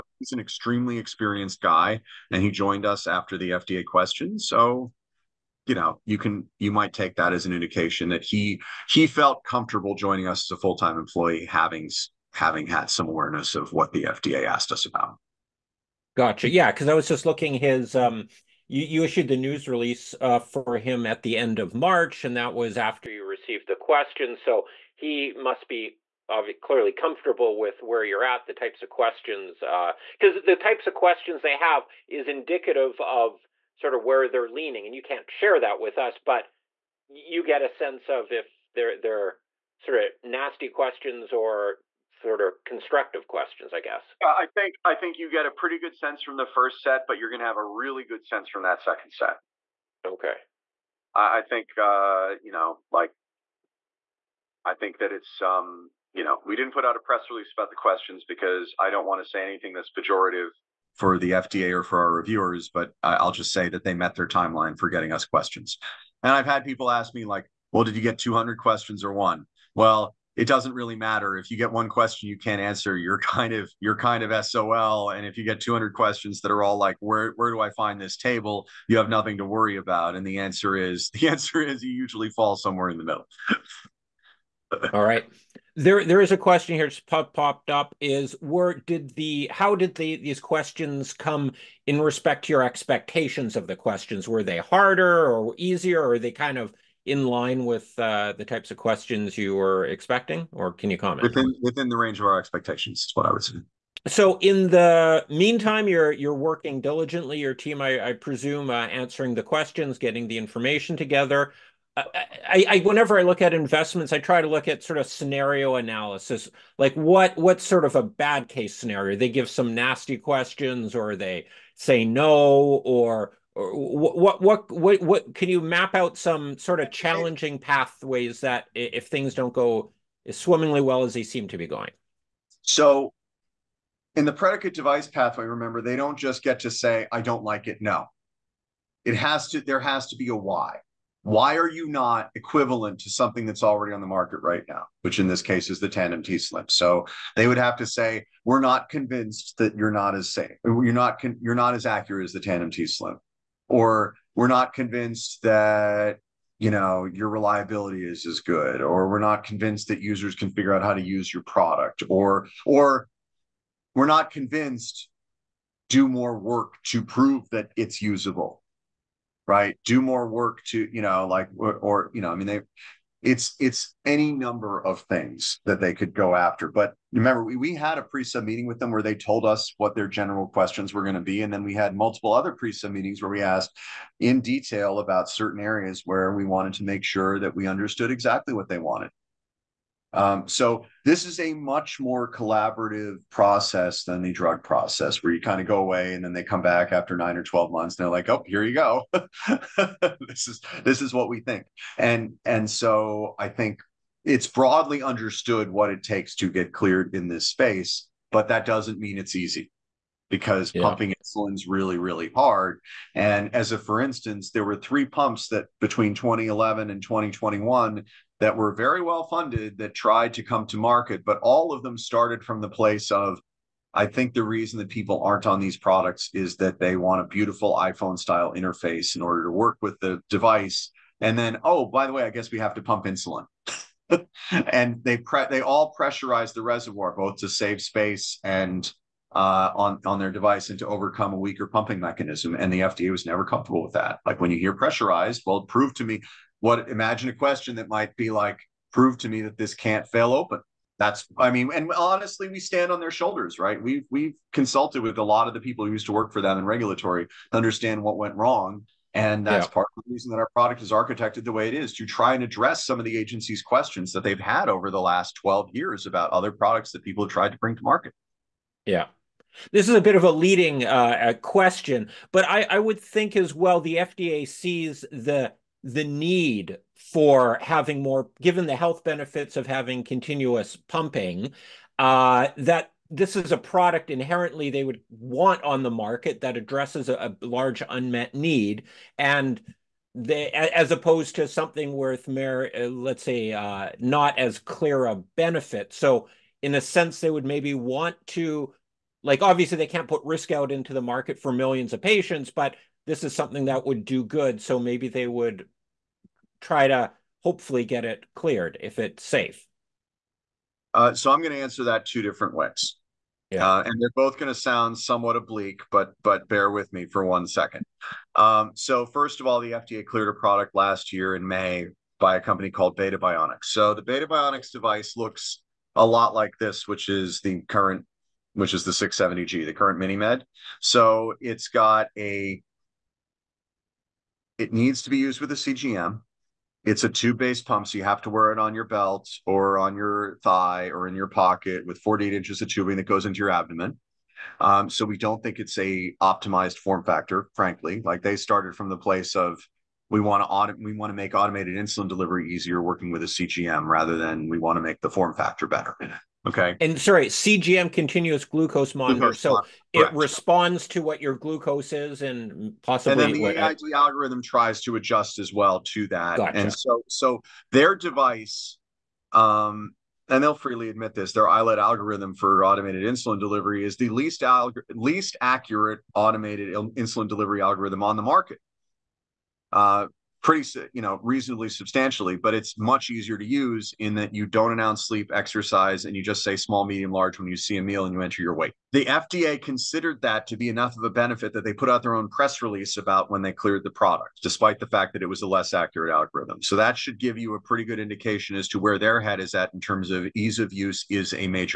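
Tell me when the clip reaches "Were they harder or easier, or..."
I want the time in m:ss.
1:34.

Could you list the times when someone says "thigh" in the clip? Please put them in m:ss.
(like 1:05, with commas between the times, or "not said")
5:40.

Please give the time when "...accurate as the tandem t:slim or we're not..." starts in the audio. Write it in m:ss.
2:31.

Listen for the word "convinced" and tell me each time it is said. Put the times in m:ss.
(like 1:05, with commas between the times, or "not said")
2:28, 2:34, 2:39, 2:44.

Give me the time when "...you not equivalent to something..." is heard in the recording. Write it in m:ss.
2:21.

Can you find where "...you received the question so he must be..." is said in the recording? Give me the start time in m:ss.
0:23.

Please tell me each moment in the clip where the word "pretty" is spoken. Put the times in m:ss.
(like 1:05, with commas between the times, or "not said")
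0:45, 6:20, 6:37.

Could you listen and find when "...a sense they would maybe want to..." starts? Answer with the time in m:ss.
4:56.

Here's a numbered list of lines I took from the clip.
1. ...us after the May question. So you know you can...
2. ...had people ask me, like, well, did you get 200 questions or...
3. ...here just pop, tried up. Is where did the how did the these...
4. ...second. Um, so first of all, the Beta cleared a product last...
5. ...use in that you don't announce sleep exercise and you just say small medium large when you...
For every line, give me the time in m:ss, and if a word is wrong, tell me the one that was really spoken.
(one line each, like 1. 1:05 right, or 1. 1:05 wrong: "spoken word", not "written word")
1. 0:02 wrong: "FDA", not "May"
2. 1:06 right
3. 1:26 wrong: "popped", not "tried"
4. 5:17 wrong: "FDA", not "Beta"
5. 6:23 right.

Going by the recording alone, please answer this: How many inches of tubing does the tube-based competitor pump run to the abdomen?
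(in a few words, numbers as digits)
48.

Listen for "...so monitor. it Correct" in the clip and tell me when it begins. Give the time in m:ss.
5:59.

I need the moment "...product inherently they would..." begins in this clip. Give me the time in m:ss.
4:43.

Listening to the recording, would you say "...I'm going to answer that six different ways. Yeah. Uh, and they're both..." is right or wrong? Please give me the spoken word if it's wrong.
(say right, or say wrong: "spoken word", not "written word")
wrong: "two", not "six".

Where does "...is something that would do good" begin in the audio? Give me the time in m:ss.
5:03.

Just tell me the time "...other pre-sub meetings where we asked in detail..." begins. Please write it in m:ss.
3:02.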